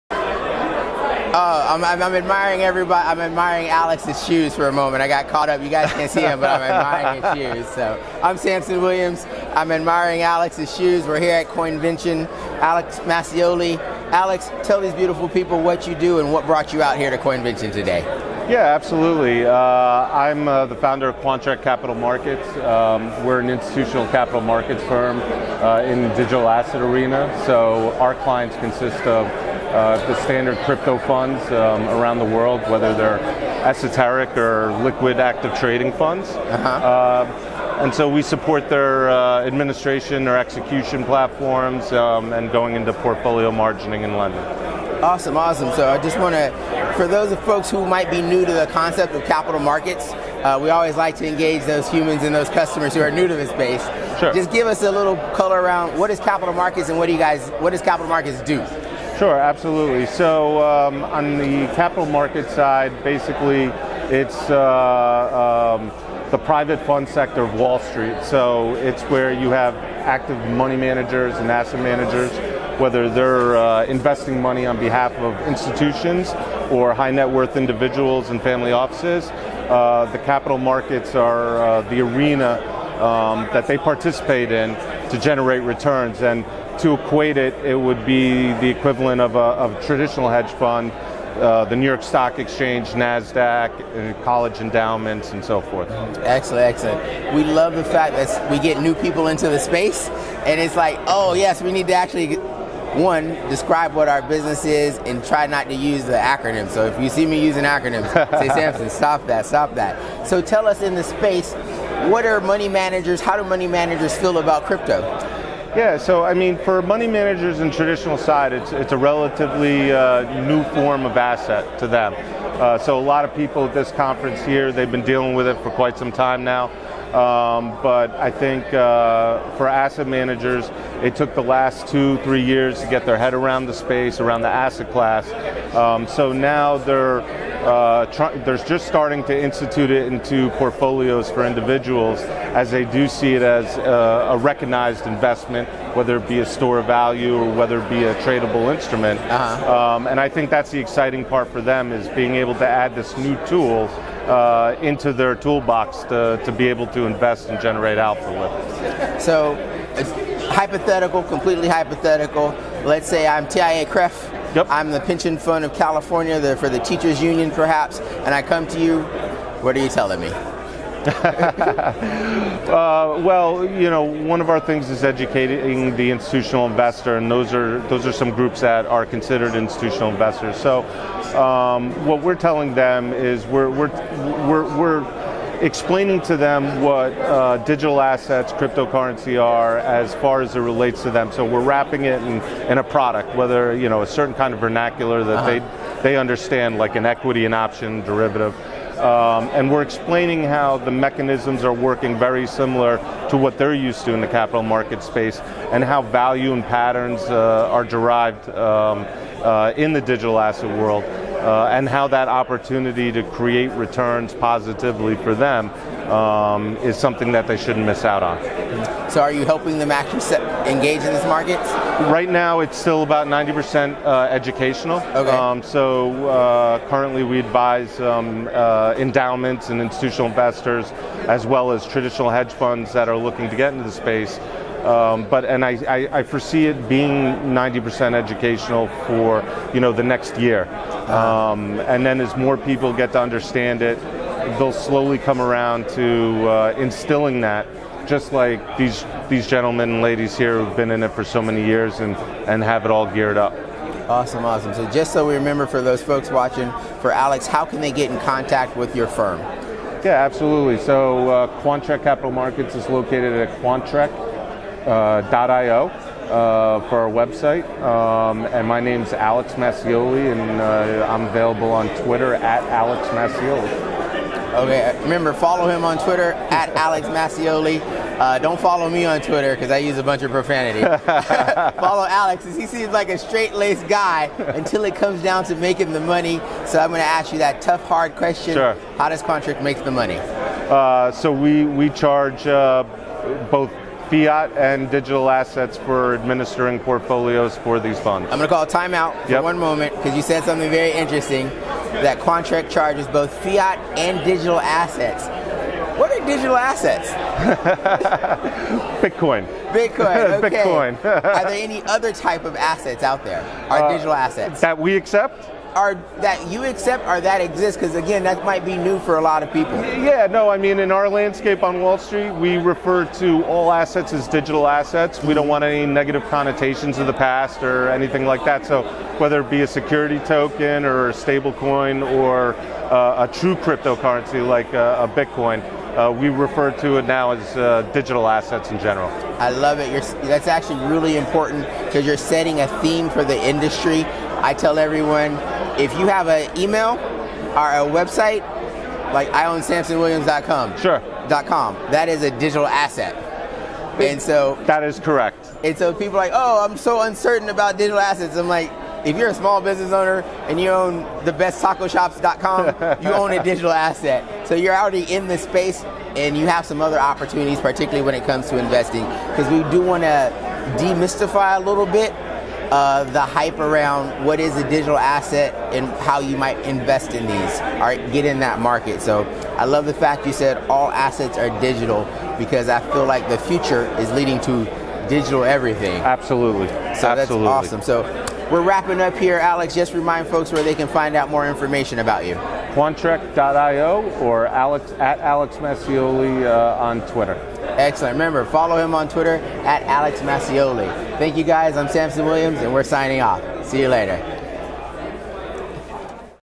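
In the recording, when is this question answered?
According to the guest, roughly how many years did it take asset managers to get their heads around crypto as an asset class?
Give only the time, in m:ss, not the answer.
2:11.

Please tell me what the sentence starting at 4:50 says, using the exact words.
Uh, so we we charge uh, both fiat and digital assets for administering portfolios for these funds.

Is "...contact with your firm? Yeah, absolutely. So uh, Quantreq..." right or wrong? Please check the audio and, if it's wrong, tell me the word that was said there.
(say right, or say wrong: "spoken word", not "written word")
right.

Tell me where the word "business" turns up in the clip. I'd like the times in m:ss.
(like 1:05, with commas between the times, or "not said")
1:44, 5:59.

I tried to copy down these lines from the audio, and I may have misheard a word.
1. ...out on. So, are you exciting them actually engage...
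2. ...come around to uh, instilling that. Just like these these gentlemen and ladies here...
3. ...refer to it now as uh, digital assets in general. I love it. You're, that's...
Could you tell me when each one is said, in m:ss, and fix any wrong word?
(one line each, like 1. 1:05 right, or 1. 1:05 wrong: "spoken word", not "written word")
1. 3:38 wrong: "helping", not "exciting"
2. 4:05 right
3. 5:36 right.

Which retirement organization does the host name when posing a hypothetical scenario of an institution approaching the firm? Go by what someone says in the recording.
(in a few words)
TIAA-CREF.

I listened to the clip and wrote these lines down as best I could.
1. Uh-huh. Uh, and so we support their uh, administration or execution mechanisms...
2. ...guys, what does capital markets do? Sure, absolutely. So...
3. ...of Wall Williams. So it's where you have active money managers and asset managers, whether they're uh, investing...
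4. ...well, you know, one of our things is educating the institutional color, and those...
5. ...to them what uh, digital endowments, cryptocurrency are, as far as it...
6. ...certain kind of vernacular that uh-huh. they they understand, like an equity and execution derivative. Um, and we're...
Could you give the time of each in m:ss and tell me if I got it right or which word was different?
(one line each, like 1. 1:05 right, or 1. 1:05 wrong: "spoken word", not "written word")
1. 0:36 wrong: "platforms", not "mechanisms"
2. 0:57 right
3. 1:07 wrong: "Street", not "Williams"
4. 2:53 wrong: "investor", not "color"
5. 3:06 wrong: "assets", not "endowments"
6. 3:14 wrong: "option", not "execution".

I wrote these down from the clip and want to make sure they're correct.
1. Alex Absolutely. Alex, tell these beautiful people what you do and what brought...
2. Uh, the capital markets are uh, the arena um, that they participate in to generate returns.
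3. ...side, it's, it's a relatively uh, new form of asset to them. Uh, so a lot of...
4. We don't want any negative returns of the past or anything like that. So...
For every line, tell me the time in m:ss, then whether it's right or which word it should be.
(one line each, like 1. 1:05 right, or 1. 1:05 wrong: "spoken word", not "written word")
1. 0:12 wrong: "Mascioli", not "Absolutely"
2. 1:19 right
3. 1:58 right
4. 5:25 wrong: "connotations", not "returns".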